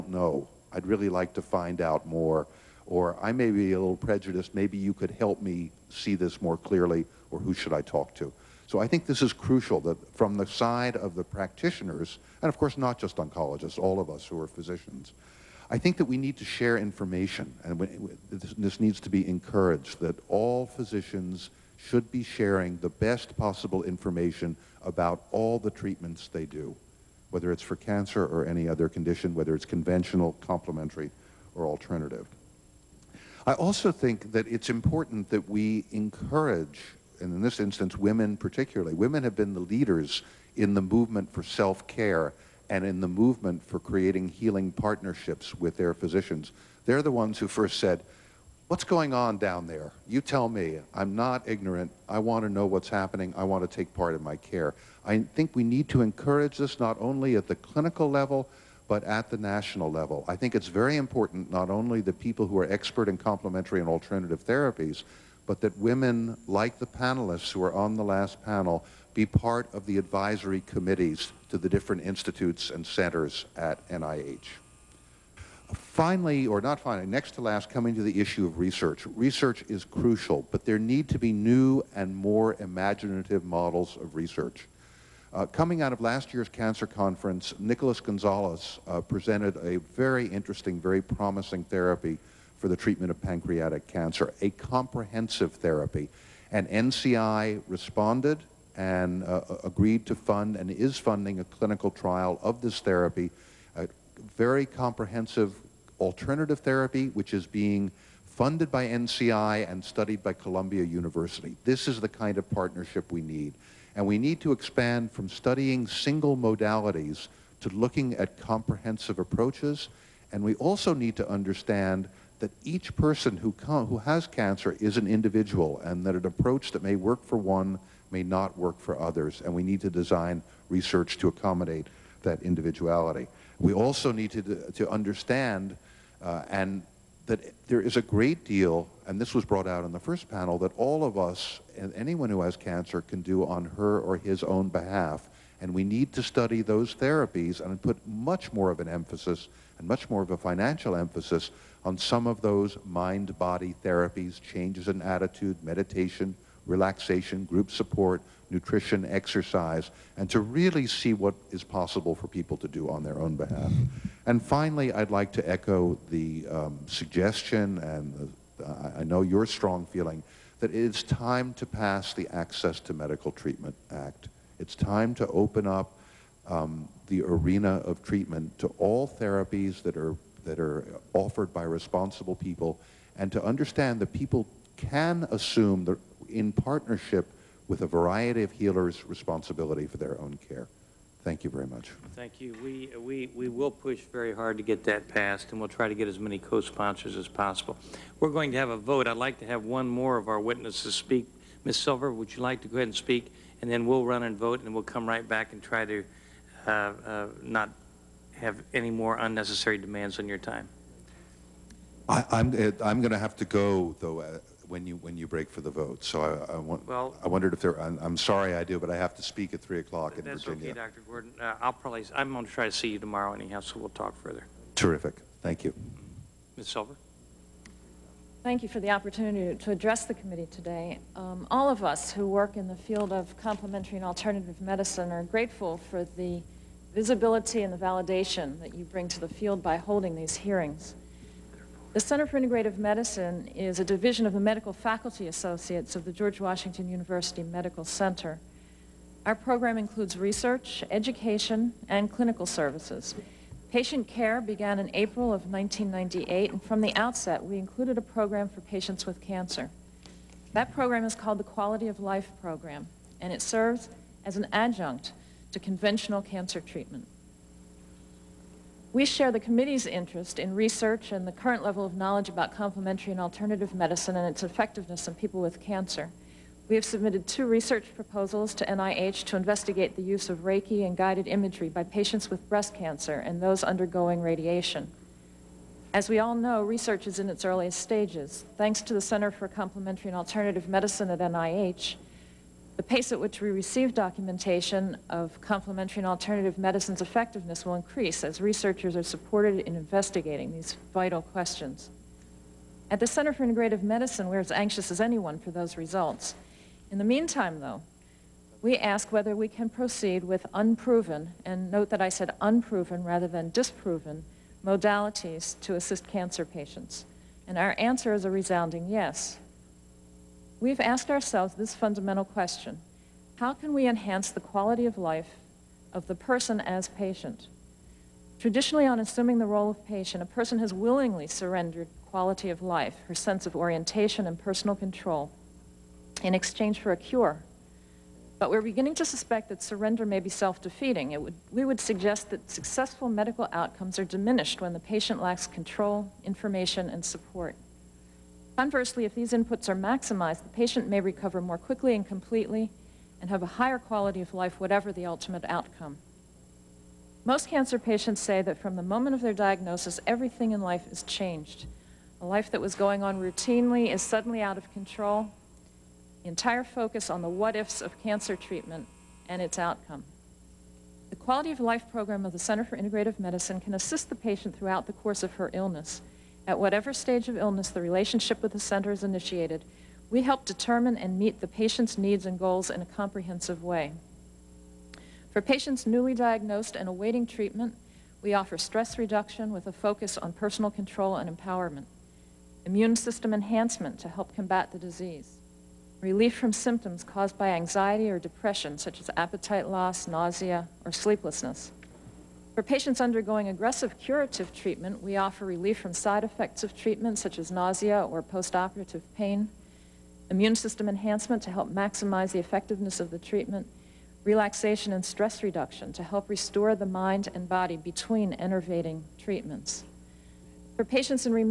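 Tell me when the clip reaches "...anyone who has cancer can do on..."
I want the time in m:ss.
2:21.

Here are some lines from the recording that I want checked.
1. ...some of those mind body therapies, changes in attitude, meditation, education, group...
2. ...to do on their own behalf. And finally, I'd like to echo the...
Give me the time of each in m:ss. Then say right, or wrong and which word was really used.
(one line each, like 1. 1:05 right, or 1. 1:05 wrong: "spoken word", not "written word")
1. 2:31 wrong: "relaxation", not "education"
2. 2:42 right.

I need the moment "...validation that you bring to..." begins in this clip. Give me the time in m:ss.
3:57.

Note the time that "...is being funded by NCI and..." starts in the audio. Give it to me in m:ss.
1:47.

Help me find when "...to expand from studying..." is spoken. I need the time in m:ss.
1:54.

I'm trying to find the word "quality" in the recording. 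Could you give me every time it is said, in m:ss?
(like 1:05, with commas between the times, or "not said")
4:21, 5:24, 5:32, 5:53, 6:11.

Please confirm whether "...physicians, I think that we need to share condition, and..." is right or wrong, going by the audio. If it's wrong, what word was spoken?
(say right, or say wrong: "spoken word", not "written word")
wrong: "information", not "condition".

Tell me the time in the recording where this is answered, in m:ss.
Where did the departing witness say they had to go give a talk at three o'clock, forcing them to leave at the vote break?
3:40.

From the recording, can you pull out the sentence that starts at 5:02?
At the Center for Integrative Medicine, we're as anxious as anyone for those results.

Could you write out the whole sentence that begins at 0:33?
I also think that it's important that we encourage, and in this instance, women particularly.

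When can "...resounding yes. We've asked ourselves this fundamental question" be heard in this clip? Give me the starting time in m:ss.
5:18.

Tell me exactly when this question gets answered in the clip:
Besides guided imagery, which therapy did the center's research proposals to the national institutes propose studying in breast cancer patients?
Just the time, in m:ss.
4:40.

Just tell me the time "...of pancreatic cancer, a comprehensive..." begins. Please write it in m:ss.
1:33.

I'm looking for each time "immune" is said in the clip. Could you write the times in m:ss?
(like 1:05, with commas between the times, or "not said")
6:32, 6:50.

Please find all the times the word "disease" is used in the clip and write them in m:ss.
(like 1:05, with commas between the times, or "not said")
6:34.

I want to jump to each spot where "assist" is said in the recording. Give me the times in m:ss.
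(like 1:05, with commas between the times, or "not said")
5:15, 6:13.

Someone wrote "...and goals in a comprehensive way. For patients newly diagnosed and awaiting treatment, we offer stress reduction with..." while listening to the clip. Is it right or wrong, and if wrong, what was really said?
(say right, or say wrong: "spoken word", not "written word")
right.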